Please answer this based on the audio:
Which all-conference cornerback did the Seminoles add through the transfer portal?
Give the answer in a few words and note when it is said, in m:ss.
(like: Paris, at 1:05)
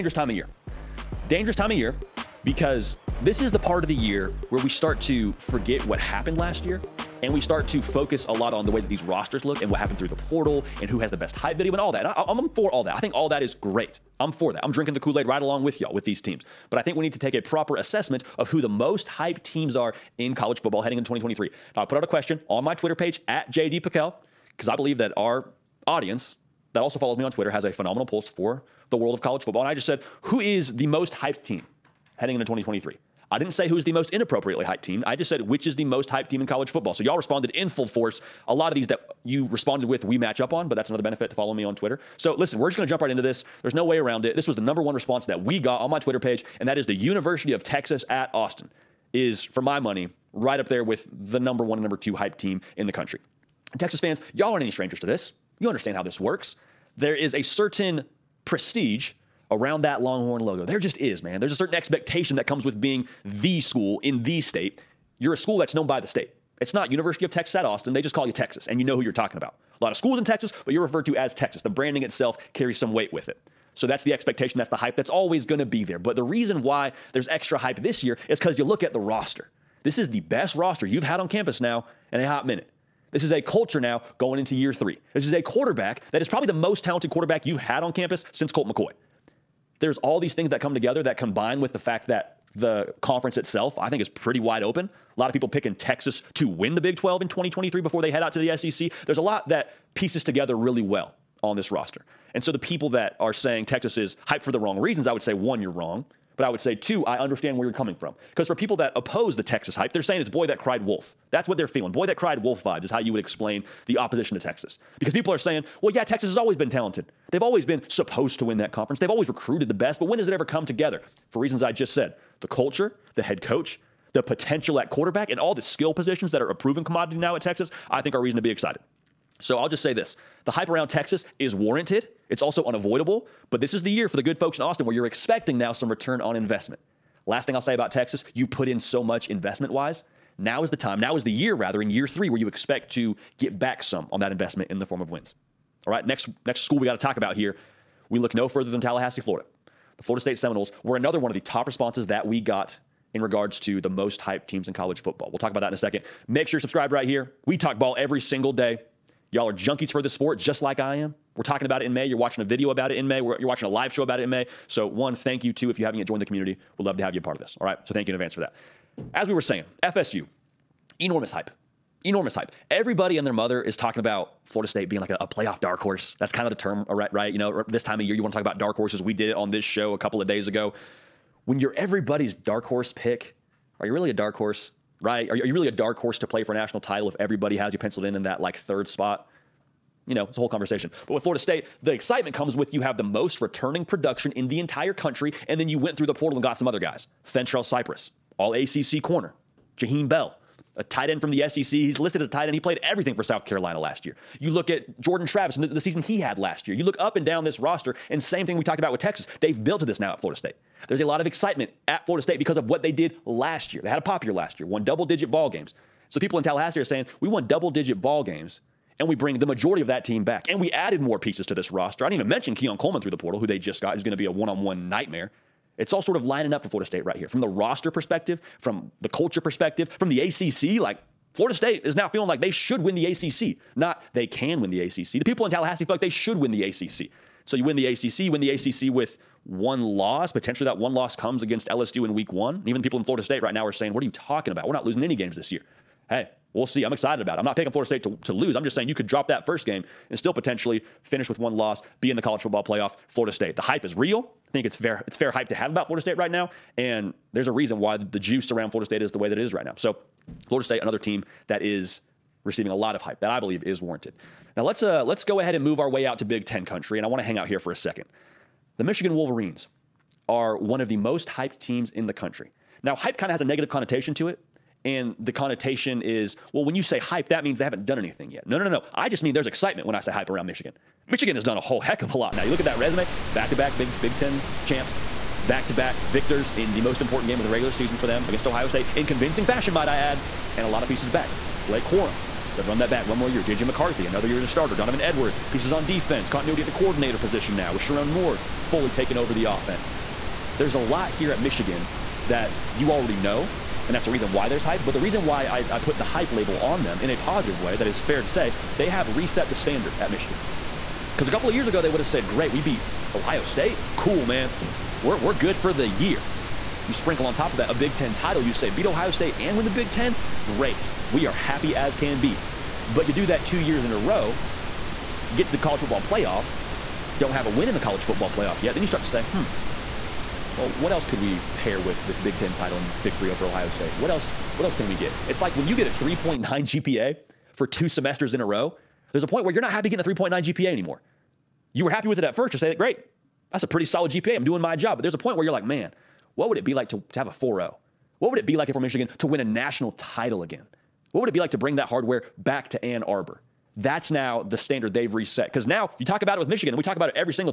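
Fentrell Cypress, at 3:17.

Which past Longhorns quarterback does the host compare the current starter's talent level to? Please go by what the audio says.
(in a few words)
Colt McCoy.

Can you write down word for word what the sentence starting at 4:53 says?
JJ McCarthy, another year as a starter.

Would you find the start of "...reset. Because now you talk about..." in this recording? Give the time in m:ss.
5:55.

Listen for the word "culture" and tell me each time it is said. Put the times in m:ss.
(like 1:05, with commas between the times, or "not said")
1:23, 2:02, 3:49.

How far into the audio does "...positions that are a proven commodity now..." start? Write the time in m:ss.
2:05.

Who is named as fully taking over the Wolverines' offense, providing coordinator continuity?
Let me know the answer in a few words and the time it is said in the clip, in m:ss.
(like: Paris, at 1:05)
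Sherrone Moore, at 4:57.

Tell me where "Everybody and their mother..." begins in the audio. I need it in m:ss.
2:52.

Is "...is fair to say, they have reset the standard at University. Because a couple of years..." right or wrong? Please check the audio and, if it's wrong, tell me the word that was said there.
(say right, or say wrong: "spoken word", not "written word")
wrong: "Michigan", not "University".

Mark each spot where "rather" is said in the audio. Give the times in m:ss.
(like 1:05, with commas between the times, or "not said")
2:21.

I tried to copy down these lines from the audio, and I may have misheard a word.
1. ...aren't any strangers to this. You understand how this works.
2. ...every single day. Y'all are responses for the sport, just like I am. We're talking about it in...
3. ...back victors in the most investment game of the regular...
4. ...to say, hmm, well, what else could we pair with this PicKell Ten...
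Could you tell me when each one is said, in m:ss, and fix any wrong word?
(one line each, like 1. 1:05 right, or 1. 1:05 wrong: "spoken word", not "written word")
1. 0:54 right
2. 2:37 wrong: "junkies", not "responses"
3. 4:45 wrong: "important", not "investment"
4. 5:29 wrong: "Big", not "PicKell".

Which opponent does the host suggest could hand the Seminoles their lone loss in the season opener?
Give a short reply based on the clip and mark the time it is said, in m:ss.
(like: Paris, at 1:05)
LSU, at 4:01.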